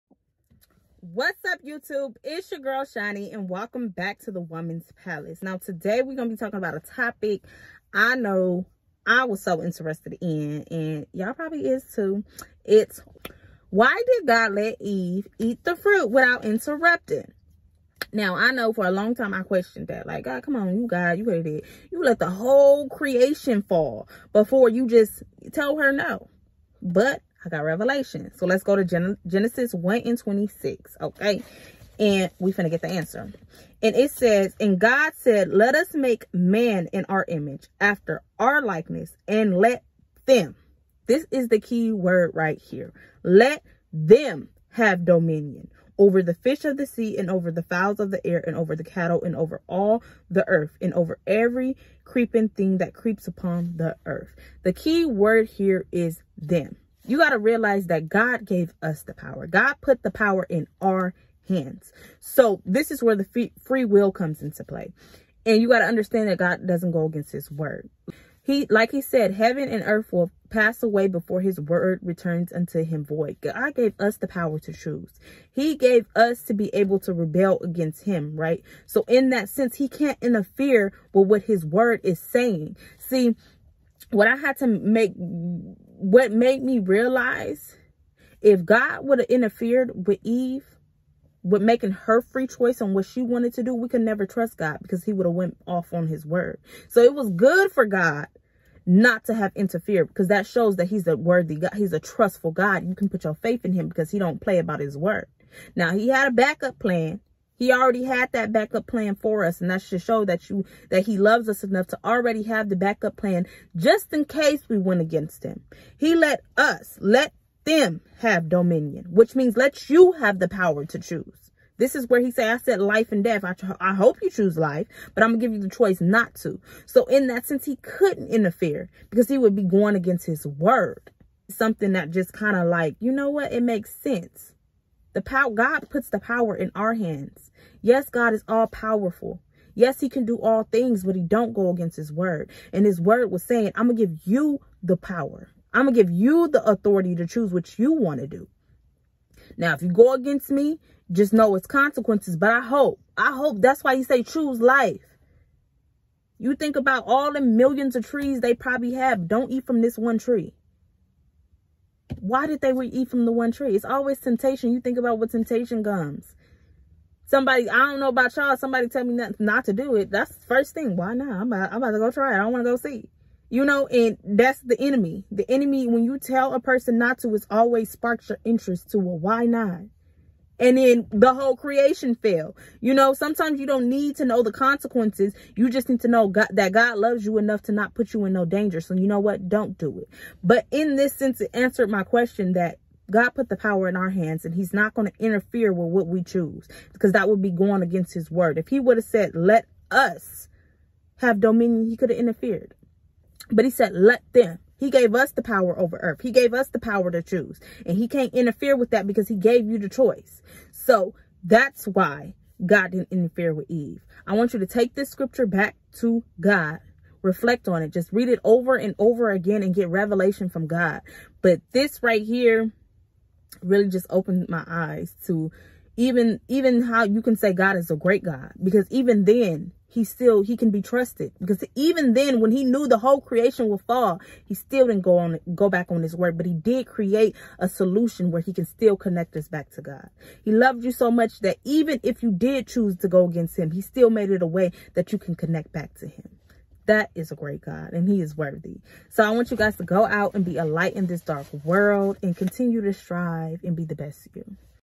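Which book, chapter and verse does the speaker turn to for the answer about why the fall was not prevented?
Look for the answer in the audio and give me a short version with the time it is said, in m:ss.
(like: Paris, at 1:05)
Genesis 1:26, at 0:29.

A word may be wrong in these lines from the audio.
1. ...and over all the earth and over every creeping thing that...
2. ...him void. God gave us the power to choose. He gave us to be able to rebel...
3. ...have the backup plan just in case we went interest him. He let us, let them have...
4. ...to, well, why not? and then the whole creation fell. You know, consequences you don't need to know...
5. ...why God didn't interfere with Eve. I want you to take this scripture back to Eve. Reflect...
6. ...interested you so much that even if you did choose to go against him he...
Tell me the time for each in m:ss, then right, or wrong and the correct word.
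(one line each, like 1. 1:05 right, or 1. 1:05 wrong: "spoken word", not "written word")
1. 0:49 right
2. 1:12 right
3. 1:52 wrong: "against", not "interest"
4. 2:58 wrong: "sometimes", not "consequences"
5. 3:31 wrong: "God", not "Eve"
6. 4:00 wrong: "loved", not "interested".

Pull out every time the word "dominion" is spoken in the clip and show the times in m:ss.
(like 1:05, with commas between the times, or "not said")
0:45, 1:58, 3:21.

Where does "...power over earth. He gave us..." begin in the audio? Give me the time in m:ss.
3:25.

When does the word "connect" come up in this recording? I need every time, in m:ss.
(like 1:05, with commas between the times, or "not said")
3:58, 4:05.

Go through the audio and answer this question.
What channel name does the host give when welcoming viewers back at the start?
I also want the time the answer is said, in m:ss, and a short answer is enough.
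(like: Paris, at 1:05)
the women's palace, at 0:04.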